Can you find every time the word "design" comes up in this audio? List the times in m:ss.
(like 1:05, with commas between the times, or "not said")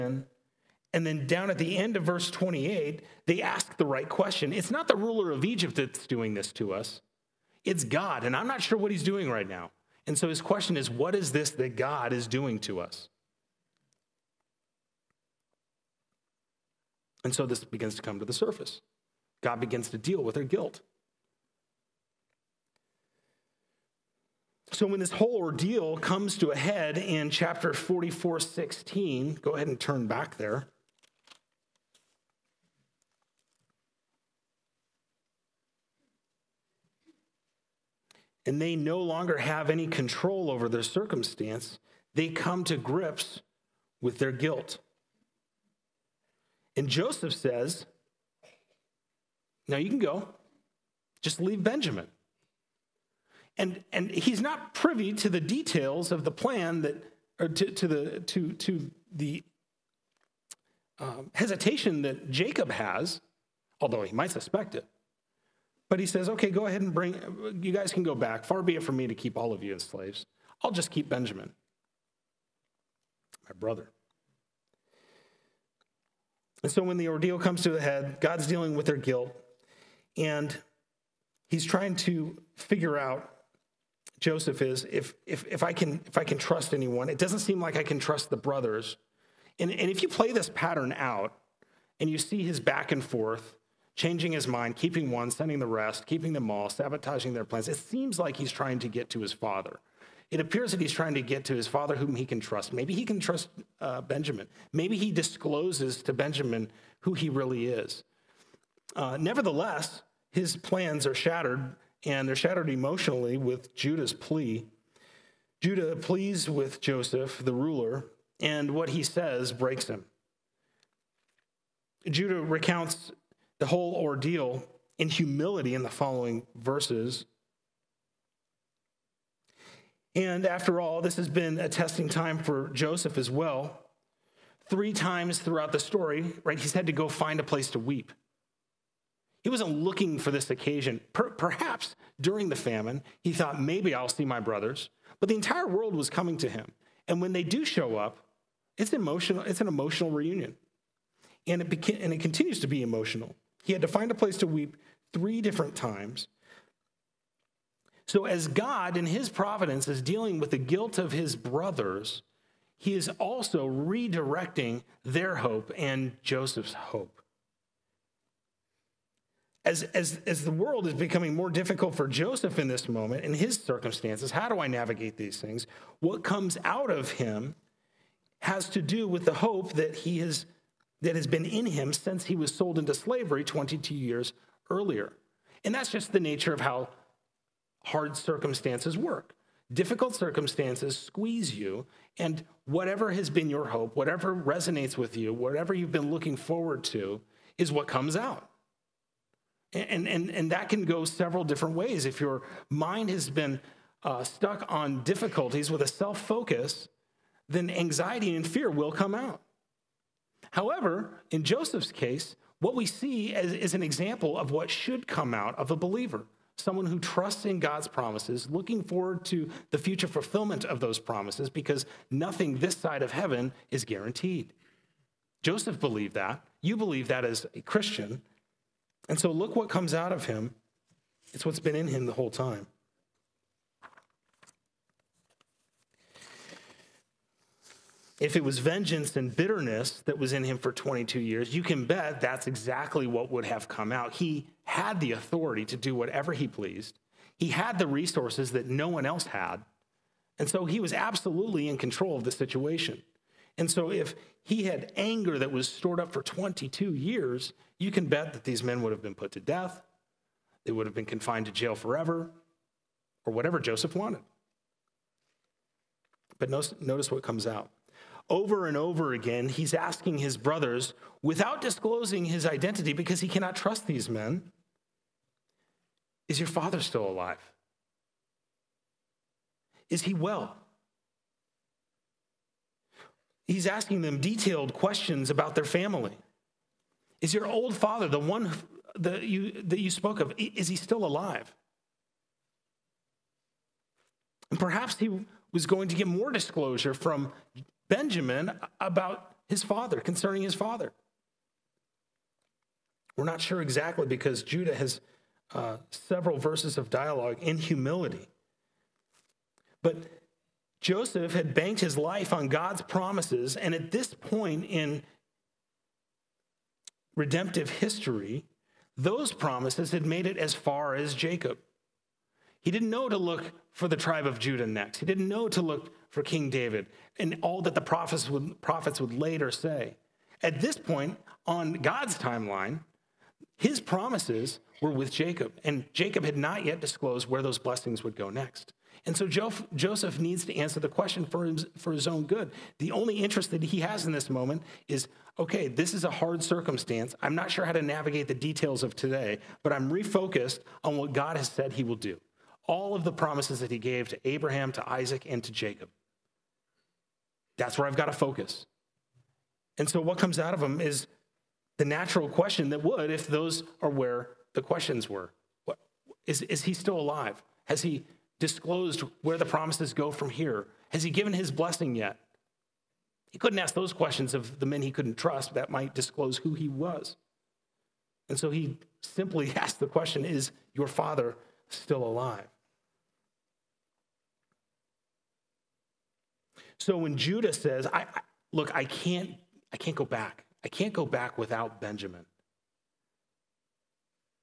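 not said.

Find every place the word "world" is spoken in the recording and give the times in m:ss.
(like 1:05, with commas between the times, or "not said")
2:25, 2:50.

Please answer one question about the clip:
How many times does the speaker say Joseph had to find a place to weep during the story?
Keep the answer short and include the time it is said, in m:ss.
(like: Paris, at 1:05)
3, at 2:14.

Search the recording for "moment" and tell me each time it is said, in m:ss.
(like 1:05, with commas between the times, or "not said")
2:52, 5:44.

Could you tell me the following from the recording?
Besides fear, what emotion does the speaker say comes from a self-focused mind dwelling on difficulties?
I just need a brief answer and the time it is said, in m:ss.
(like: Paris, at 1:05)
Anxiety, at 3:27.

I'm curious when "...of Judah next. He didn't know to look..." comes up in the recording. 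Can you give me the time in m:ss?
5:24.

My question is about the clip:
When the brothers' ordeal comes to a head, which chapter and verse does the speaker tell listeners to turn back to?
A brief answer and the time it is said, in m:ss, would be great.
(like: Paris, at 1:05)
Chapter 44:16, at 0:27.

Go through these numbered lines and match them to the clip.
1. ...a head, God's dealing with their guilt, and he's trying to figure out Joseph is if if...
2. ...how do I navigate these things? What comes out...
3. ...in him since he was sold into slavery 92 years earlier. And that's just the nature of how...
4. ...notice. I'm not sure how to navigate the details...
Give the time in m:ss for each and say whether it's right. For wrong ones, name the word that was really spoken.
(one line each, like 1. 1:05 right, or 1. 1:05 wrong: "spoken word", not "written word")
1. 1:17 right
2. 2:54 right
3. 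3:01 wrong: "22", not "92"
4. 5:46 wrong: "circumstance", not "notice".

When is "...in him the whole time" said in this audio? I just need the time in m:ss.
3:51.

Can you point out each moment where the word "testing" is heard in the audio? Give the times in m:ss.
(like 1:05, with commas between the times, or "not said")
2:11.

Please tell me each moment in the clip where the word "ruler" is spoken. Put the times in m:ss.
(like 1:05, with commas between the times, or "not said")
0:04, 1:57.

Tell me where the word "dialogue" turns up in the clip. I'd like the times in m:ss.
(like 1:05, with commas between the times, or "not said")
5:06.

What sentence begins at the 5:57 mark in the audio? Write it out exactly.
That's where I've got to focus.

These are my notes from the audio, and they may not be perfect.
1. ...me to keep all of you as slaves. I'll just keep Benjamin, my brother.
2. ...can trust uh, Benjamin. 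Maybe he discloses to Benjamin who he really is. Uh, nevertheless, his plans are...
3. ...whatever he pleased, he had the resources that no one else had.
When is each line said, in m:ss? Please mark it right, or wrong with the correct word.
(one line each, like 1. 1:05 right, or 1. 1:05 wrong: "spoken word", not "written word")
1. 1:08 right
2. 1:43 right
3. 4:05 right.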